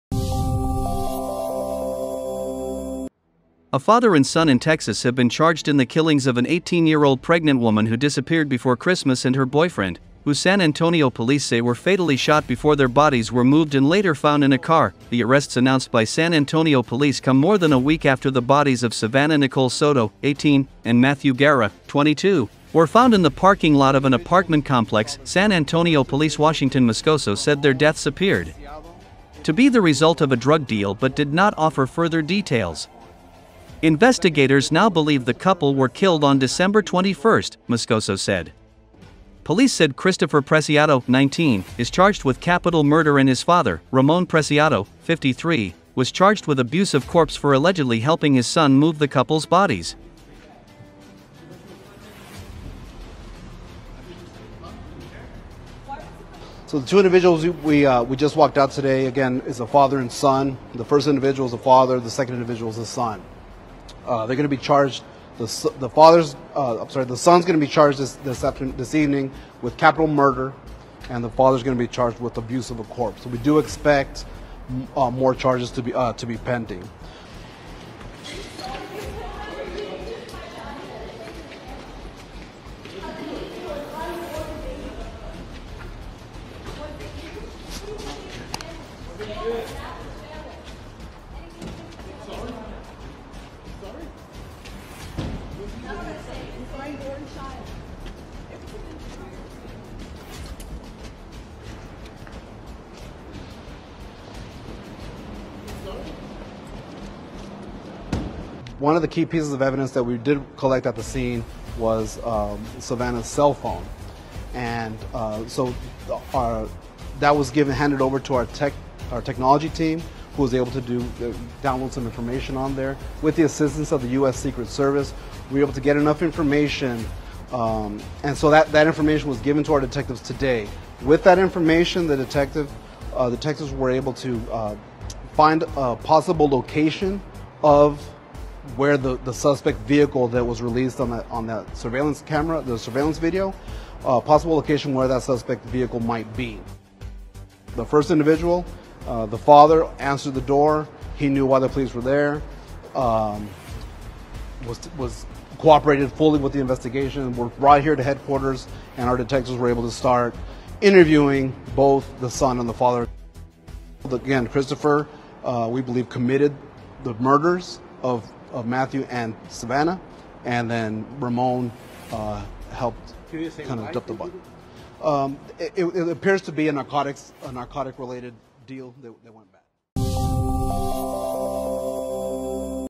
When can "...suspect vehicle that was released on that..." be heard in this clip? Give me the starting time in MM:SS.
02:19.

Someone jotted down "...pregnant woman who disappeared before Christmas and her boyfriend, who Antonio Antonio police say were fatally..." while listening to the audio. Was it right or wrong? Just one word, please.
wrong.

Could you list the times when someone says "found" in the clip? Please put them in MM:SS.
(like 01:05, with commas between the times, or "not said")
00:14, 00:22.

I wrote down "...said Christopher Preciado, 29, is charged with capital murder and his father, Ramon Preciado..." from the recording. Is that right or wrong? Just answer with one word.
wrong.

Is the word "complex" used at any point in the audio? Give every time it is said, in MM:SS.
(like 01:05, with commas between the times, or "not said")
00:24.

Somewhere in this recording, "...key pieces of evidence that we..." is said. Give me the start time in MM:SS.
01:49.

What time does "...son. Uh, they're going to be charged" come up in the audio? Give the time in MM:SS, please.
01:02.